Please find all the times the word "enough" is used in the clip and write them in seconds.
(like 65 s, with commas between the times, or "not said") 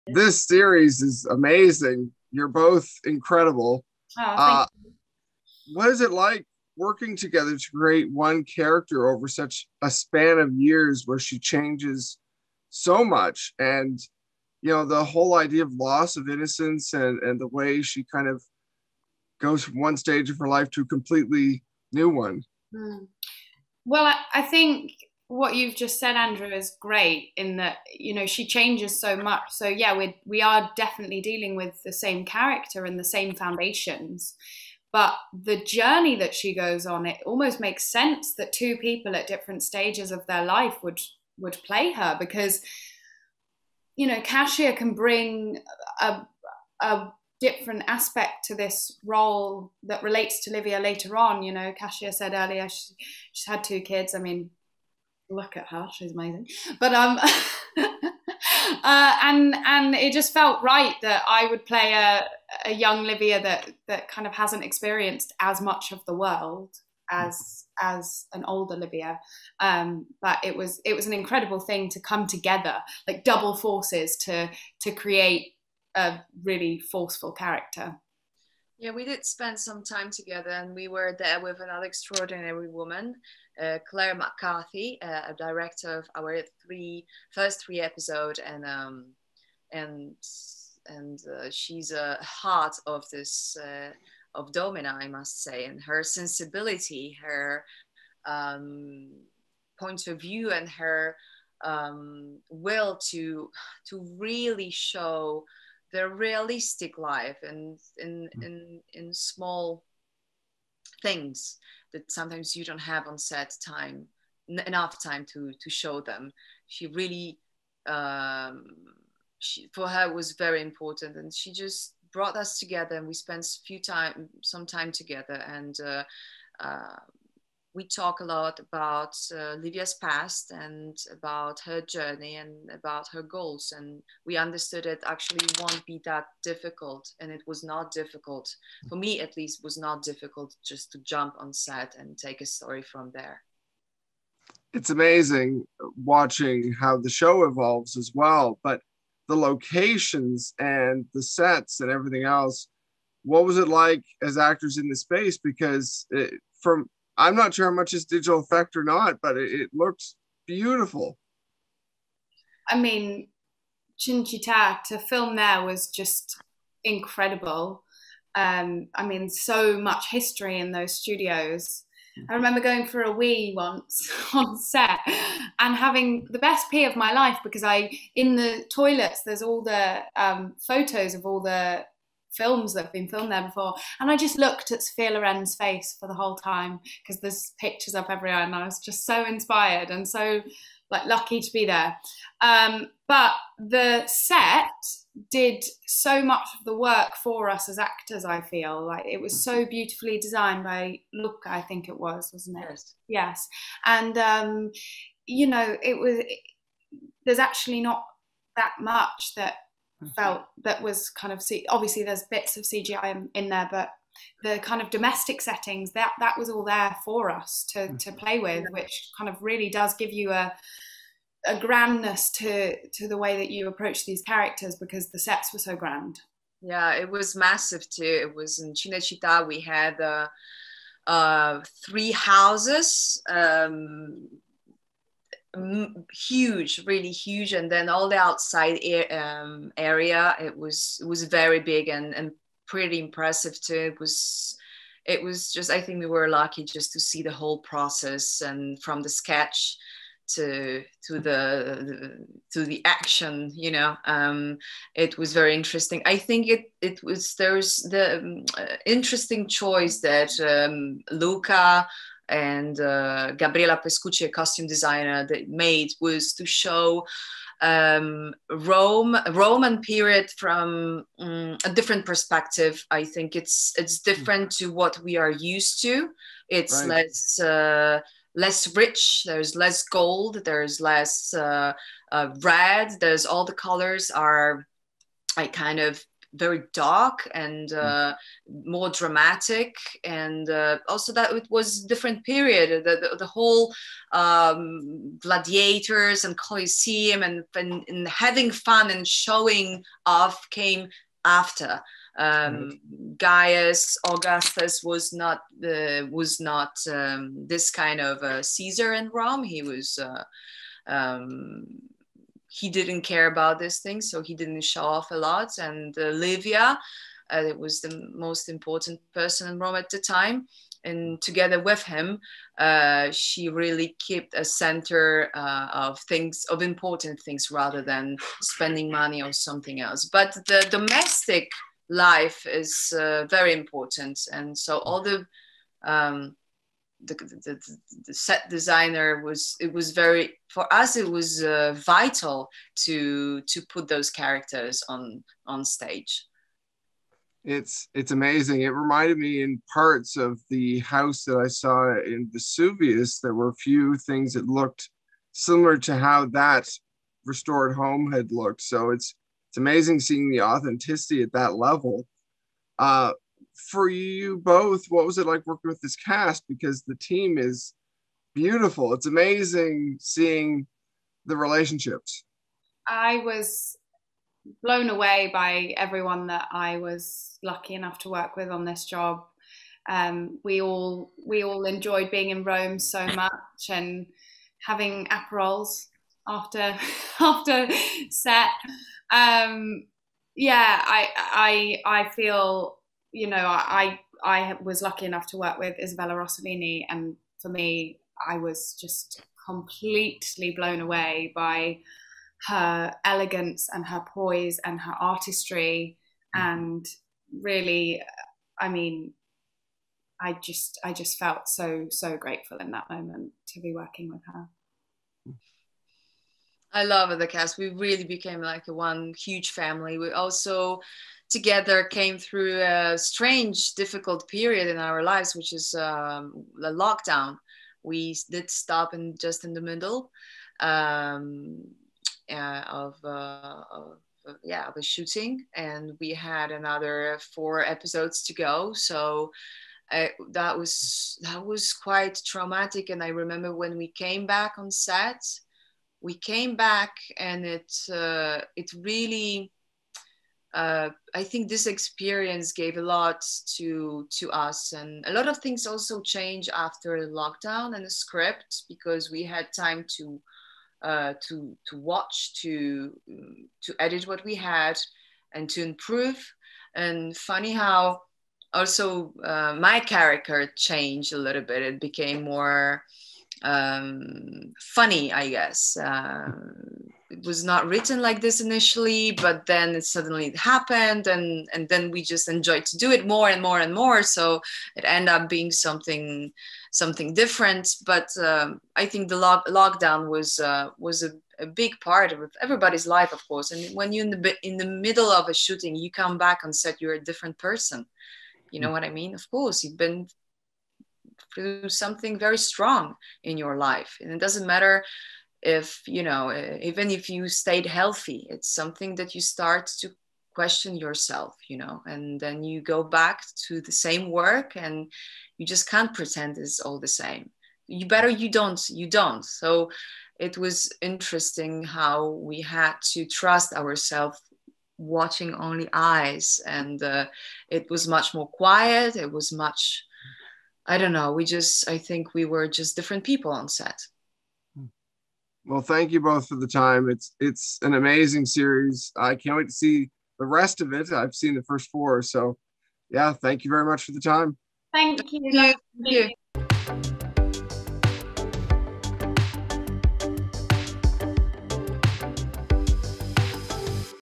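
114 s, 377 s, 395 s.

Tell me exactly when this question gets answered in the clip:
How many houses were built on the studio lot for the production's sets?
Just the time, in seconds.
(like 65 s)
231 s.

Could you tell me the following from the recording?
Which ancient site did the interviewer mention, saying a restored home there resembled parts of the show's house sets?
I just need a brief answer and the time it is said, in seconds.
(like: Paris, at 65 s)
Vesuvius, at 352 s.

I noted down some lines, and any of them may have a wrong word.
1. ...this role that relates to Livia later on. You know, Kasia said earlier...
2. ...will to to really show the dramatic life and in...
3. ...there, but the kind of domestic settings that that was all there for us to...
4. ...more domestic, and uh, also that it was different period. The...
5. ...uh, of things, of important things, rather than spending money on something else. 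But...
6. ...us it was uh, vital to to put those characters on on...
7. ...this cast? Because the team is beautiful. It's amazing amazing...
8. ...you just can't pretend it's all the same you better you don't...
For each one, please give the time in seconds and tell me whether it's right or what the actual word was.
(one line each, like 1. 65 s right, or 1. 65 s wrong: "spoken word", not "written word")
1. 48 s right
2. 102 s wrong: "realistic", not "dramatic"
3. 213 s right
4. 288 s wrong: "dramatic", not "domestic"
5. 325 s right
6. 340 s right
7. 365 s wrong: "seeing", not "amazing"
8. 515 s right.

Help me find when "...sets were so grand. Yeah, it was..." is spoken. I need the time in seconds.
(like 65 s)
225 s.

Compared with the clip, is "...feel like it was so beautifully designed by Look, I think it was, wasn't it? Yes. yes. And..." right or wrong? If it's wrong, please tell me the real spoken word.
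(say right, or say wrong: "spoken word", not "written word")
right.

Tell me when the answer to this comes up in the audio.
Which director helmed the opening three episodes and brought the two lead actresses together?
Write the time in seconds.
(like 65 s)
83 s.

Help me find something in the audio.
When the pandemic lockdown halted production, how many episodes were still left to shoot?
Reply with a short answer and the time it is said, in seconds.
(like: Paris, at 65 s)
4, at 436 s.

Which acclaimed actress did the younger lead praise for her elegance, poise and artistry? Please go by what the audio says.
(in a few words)
Isabella Rossellini.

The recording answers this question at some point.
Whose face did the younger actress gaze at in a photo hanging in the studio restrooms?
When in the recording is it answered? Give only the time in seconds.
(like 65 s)
184 s.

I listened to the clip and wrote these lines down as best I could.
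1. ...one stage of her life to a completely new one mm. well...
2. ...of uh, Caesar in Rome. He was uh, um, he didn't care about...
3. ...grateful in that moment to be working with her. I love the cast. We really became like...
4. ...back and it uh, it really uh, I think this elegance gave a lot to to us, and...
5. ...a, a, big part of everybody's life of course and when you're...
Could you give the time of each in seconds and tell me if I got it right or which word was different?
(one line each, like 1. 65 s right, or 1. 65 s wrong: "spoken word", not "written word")
1. 19 s right
2. 308 s right
3. 412 s right
4. 446 s wrong: "experience", not "elegance"
5. 491 s right.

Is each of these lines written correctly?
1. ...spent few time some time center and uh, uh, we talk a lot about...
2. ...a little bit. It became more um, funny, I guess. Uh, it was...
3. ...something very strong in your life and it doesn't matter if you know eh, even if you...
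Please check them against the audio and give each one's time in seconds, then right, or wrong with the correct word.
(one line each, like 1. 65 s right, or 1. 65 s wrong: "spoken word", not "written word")
1. 123 s wrong: "together", not "center"
2. 471 s right
3. 501 s right.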